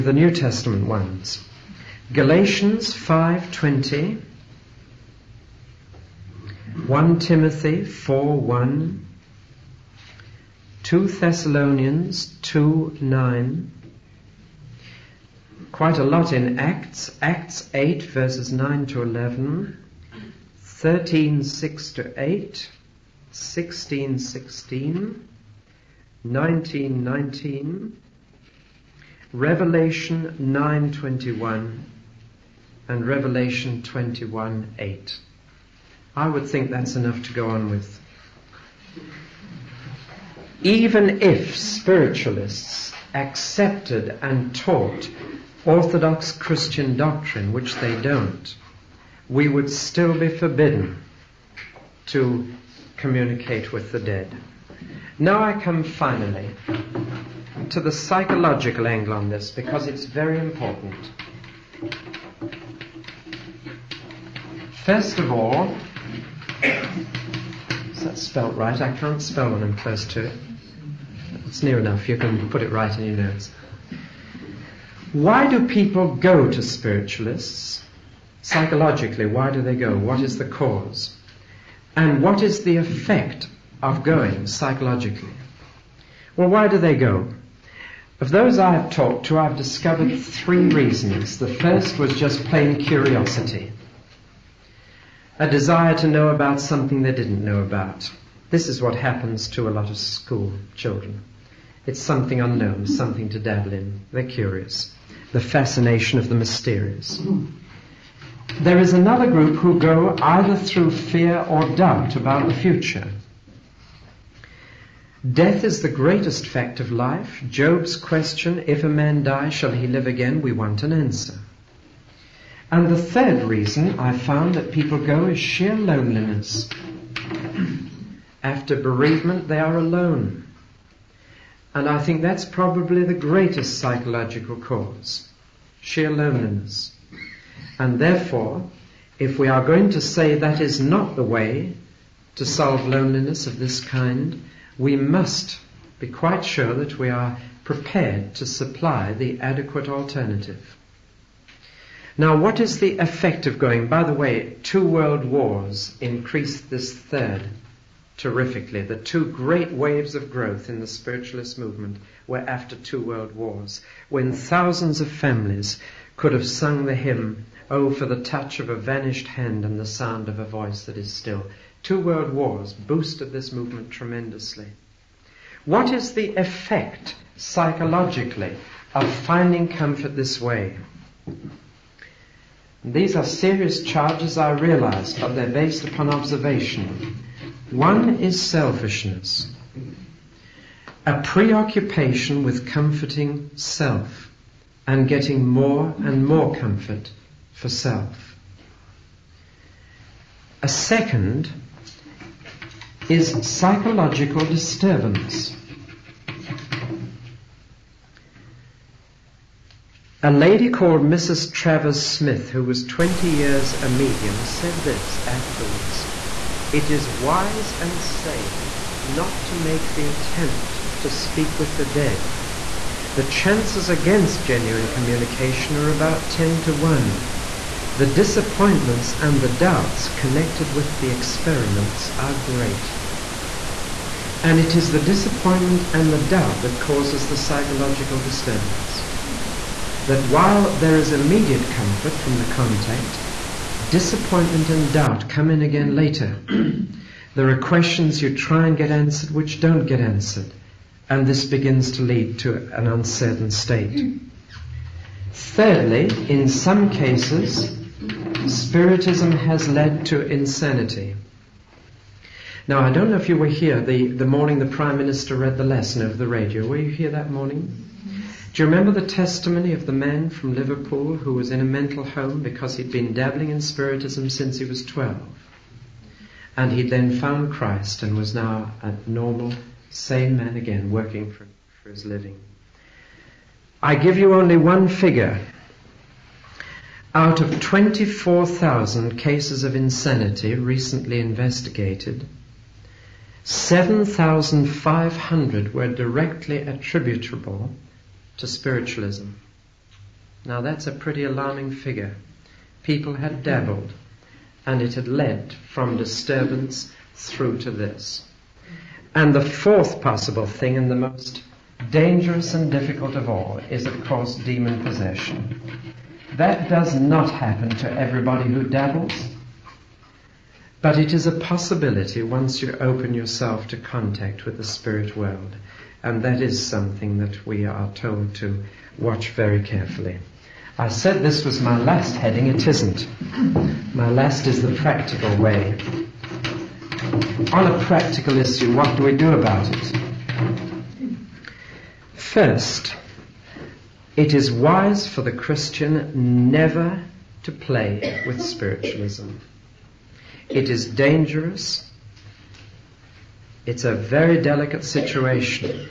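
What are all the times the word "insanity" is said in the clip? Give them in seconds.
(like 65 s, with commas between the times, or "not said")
260 s, 289 s.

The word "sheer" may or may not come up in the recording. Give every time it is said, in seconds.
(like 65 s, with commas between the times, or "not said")
125 s, 135 s.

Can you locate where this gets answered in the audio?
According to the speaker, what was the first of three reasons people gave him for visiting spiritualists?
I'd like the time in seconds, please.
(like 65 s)
92 s.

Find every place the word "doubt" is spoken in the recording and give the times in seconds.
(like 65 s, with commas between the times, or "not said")
111 s, 229 s, 236 s, 244 s.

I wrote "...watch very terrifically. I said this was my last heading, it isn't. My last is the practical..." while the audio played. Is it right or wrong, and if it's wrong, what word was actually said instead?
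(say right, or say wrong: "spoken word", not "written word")
wrong: "carefully", not "terrifically".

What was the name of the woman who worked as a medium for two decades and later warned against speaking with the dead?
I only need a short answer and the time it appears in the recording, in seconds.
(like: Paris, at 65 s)
Mrs. Travers Smith, at 211 s.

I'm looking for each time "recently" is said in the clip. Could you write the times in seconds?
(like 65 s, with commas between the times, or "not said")
290 s.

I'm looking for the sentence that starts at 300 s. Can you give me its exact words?
Now that's a pretty alarming figure.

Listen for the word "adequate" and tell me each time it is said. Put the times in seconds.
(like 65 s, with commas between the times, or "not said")
149 s.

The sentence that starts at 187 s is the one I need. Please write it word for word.
One is selfishness, a preoccupation with comforting self and getting more and more comfort for self.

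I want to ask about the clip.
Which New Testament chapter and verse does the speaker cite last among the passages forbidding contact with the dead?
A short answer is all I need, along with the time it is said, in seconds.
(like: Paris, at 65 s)
Revelation 21:8, at 33 s.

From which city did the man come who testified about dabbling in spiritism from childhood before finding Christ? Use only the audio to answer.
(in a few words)
Liverpool.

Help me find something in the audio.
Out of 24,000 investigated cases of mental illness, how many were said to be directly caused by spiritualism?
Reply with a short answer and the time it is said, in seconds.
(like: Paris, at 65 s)
7,500, at 293 s.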